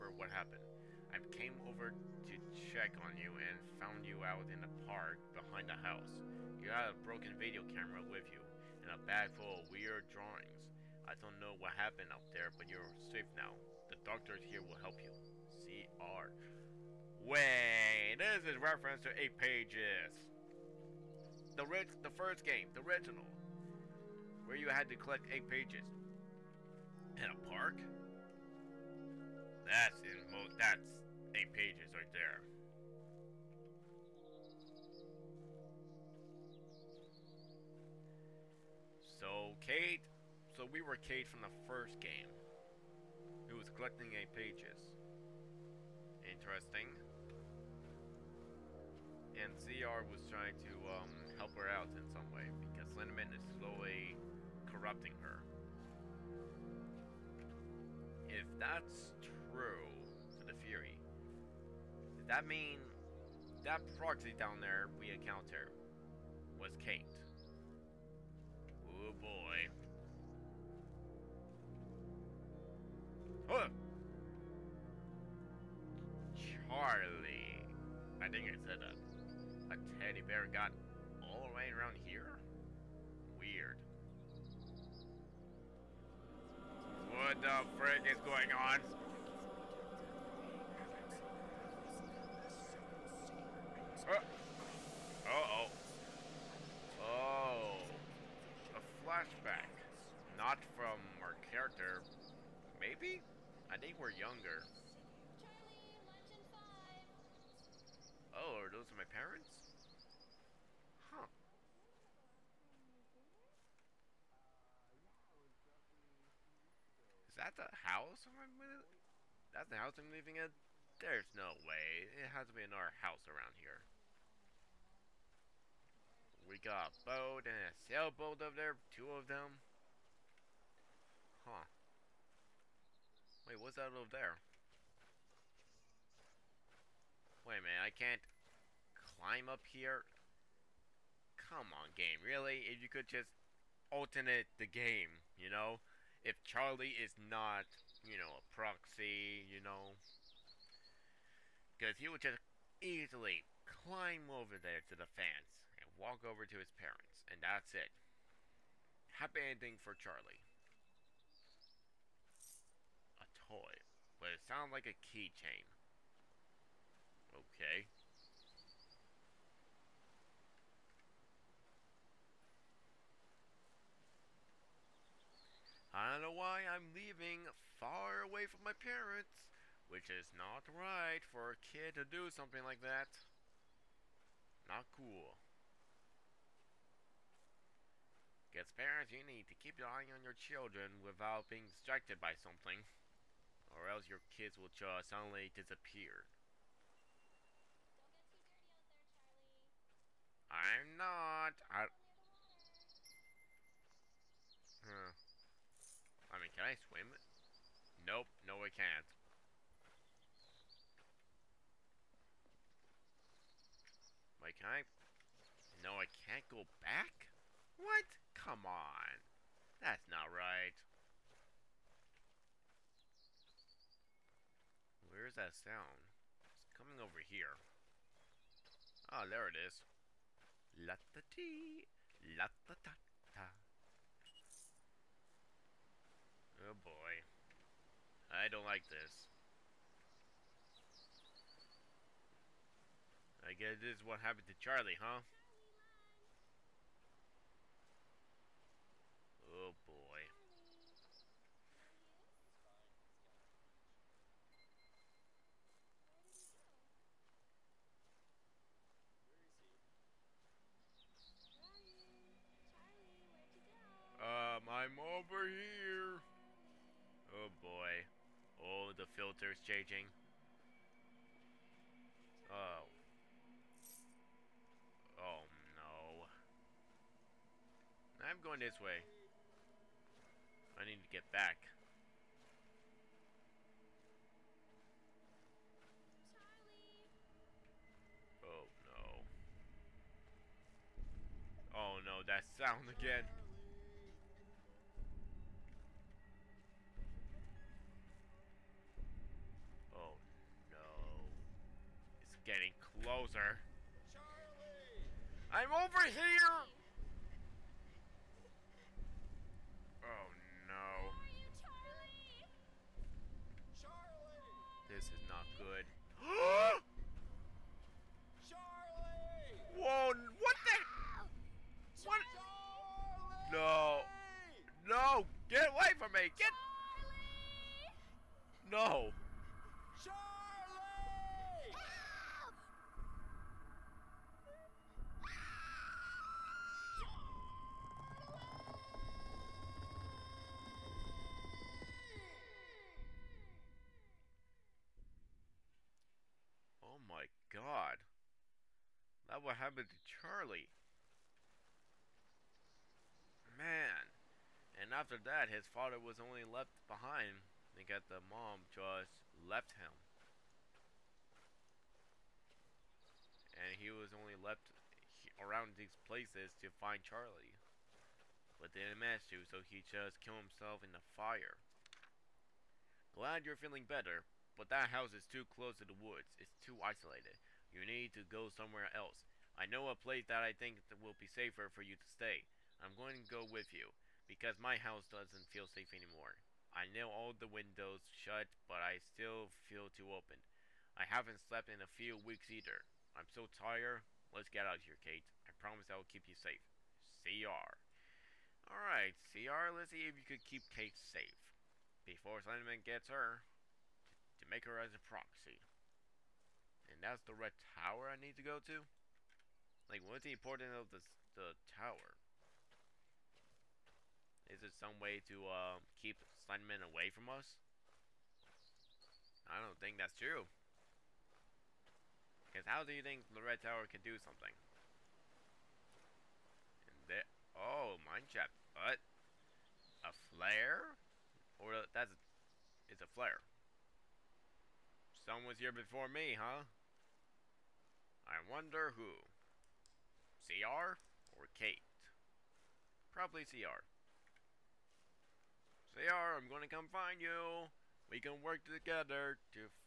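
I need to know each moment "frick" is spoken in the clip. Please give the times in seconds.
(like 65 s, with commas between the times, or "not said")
87 s.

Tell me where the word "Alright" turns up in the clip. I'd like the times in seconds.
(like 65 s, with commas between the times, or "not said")
398 s.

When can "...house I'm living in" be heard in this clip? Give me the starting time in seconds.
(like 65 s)
119 s.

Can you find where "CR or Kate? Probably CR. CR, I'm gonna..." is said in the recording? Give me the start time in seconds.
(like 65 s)
440 s.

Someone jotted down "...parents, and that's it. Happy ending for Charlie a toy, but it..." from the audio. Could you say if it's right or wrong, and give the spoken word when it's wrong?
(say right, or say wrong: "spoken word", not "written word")
right.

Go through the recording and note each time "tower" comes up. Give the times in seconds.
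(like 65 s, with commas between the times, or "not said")
407 s, 411 s, 423 s.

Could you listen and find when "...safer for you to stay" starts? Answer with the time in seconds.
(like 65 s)
381 s.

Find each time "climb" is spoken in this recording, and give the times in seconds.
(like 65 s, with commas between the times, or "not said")
138 s, 153 s.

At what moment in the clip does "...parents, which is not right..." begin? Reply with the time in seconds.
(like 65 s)
178 s.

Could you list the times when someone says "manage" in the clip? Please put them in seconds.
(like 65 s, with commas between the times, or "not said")
368 s.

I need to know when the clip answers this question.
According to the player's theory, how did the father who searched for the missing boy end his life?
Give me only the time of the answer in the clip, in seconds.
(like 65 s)
370 s.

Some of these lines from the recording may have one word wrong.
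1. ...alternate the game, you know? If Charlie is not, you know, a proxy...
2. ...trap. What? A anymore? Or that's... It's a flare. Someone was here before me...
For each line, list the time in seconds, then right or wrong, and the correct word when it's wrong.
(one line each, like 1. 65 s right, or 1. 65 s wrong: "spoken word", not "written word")
1. 143 s right
2. 428 s wrong: "flare", not "anymore".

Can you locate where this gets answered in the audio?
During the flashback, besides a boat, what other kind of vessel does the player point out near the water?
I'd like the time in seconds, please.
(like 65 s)
127 s.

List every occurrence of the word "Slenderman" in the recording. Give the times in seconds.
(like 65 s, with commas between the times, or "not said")
402 s, 416 s.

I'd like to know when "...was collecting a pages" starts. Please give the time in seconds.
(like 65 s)
43 s.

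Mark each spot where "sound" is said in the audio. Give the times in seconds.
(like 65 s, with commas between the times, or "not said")
164 s, 225 s, 292 s.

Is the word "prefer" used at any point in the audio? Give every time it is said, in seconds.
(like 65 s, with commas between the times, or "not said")
not said.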